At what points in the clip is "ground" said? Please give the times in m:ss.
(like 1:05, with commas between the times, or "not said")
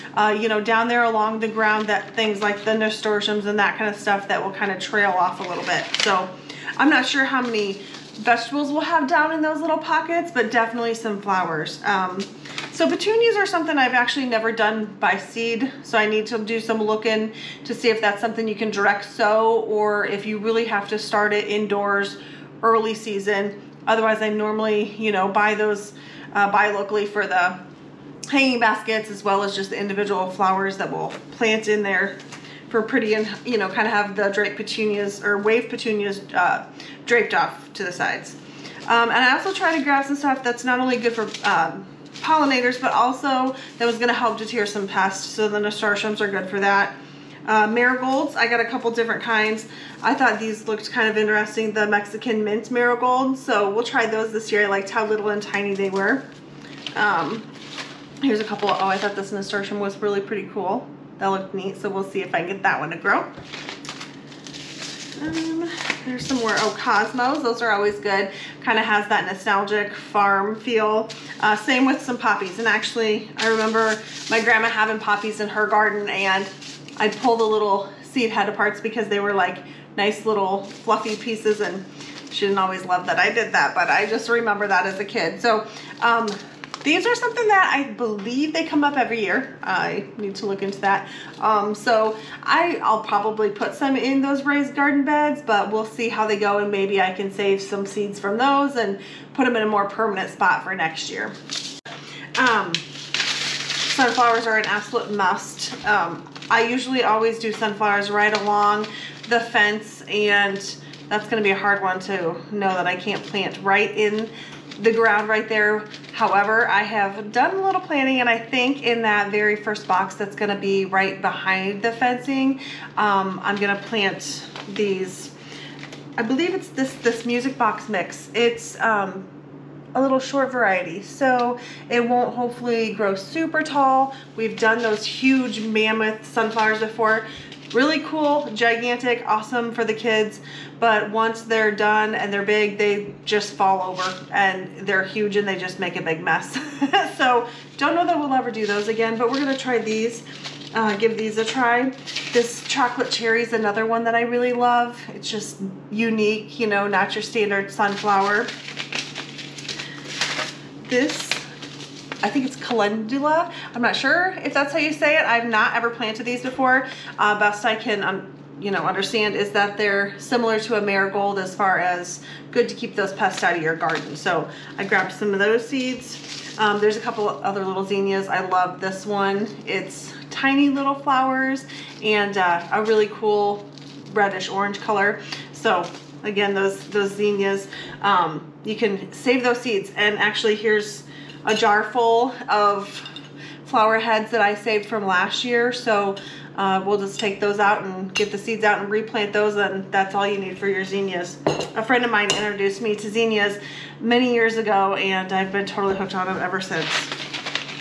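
0:01, 1:54.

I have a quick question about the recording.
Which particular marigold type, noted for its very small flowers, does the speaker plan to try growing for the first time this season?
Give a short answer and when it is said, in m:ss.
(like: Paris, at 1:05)
Mexican mint marigold, at 0:51.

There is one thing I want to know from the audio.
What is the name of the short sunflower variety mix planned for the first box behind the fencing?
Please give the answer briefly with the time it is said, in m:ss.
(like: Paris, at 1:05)
Music box mix, at 2:07.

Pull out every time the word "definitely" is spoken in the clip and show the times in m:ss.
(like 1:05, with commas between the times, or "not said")
0:10.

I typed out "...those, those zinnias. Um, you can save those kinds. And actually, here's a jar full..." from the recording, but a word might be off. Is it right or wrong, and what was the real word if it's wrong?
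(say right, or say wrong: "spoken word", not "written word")
wrong: "seeds", not "kinds".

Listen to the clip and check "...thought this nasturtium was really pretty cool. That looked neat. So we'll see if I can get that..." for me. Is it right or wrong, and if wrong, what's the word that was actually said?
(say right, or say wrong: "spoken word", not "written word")
right.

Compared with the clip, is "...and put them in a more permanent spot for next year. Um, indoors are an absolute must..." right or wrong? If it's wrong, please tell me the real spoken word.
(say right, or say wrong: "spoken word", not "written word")
wrong: "sunflowers", not "indoors".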